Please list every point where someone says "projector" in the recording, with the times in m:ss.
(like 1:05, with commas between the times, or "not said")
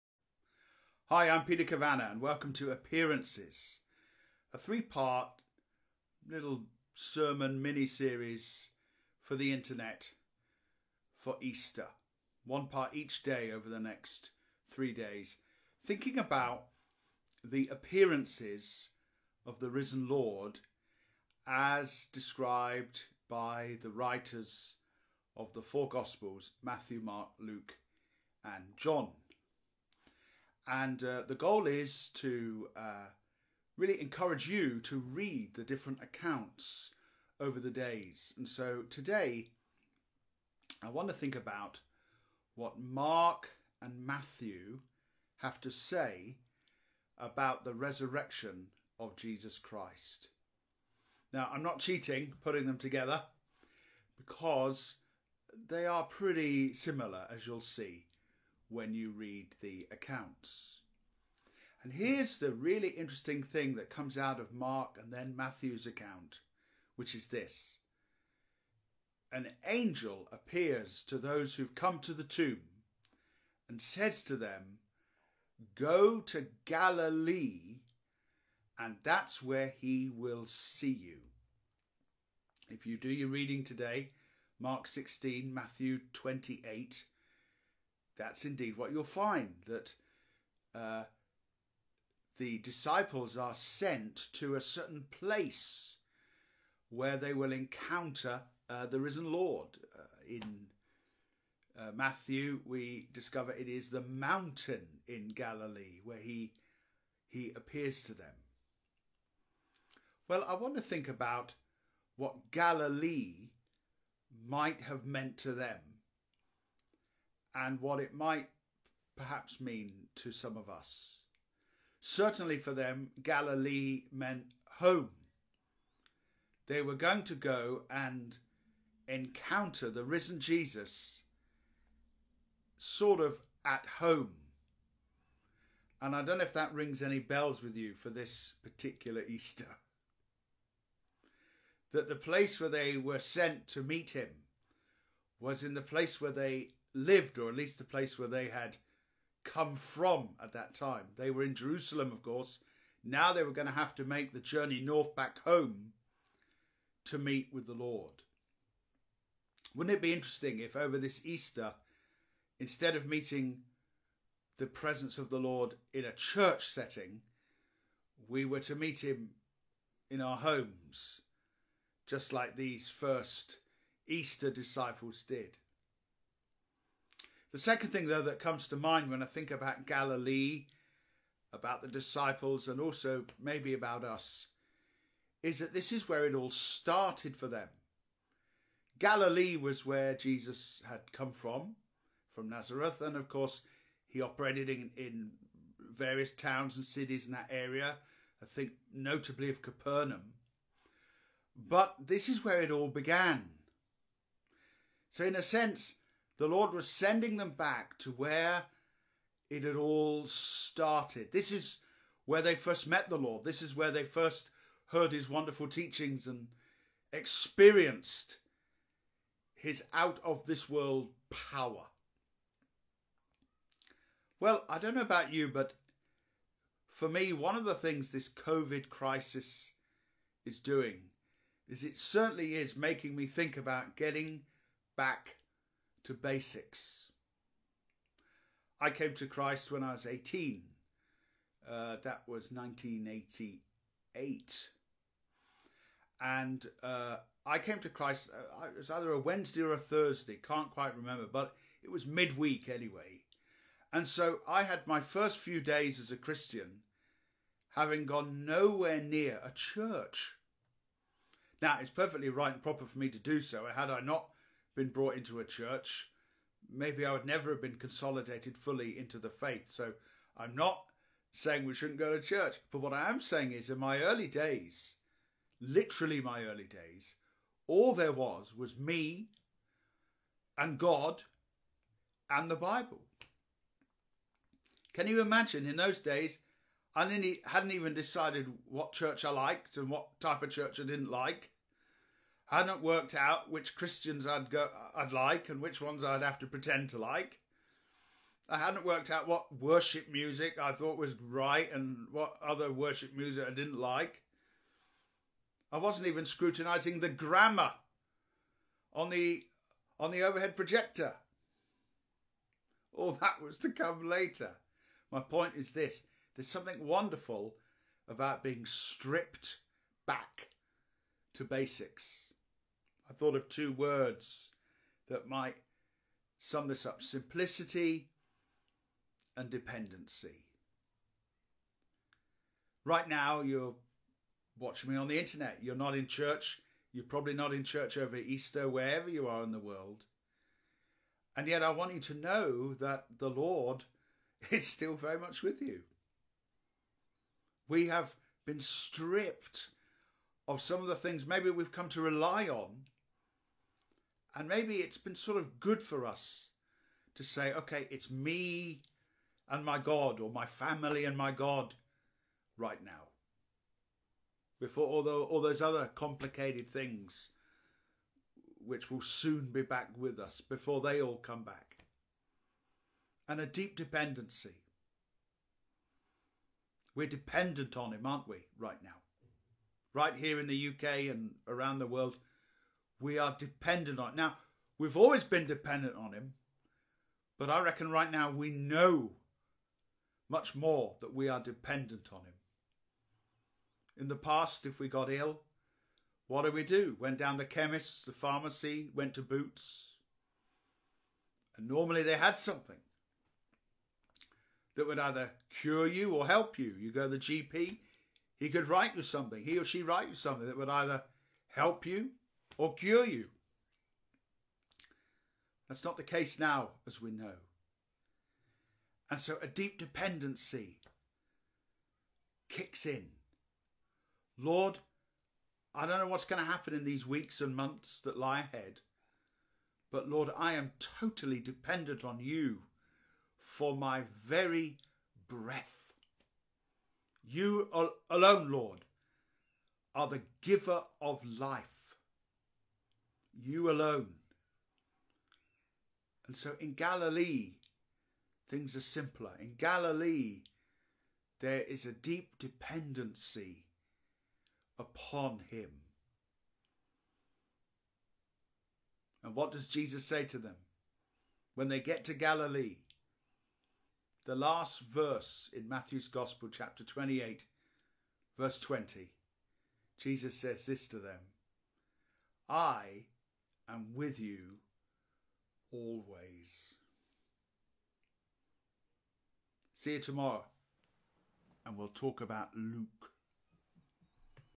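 5:10.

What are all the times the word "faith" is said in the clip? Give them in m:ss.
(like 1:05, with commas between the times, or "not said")
4:29.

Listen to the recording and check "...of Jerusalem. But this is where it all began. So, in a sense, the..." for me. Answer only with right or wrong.
wrong.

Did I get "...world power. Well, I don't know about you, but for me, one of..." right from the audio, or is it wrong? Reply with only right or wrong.
right.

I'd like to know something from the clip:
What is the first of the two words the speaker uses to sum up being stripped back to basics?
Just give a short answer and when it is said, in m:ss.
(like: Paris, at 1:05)
simplicity, at 5:27.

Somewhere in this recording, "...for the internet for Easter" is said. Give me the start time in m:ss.
0:09.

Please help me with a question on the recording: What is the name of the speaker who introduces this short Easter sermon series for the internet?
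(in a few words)
Peter Cavana.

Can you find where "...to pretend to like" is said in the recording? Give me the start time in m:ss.
4:56.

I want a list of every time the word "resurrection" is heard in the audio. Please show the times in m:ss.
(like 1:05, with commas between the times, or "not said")
0:47.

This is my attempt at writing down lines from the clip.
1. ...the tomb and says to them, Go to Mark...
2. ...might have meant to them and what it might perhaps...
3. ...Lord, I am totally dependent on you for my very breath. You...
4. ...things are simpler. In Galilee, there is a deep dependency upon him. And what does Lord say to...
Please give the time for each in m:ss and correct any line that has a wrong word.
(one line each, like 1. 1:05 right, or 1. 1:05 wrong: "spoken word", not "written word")
1. 1:12 wrong: "Galilee", not "Mark"
2. 1:54 right
3. 7:10 right
4. 7:28 wrong: "Jesus", not "Lord".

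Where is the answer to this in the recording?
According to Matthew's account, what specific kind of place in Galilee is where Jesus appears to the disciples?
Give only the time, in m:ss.
1:43.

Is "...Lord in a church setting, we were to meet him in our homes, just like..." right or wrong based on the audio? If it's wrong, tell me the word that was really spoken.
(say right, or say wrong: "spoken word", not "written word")
right.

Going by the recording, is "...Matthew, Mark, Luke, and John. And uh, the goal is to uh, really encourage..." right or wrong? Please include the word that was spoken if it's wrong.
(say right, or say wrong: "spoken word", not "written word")
right.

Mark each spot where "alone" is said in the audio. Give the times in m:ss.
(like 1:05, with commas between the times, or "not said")
7:18, 7:23.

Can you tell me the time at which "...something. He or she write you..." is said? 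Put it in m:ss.
6:49.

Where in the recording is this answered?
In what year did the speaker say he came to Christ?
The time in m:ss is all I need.
4:02.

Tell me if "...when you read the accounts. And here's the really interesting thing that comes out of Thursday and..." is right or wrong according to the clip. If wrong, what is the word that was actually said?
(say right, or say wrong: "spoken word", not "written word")
wrong: "Mark", not "Thursday".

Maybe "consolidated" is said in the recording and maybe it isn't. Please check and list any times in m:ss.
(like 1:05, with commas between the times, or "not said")
4:27.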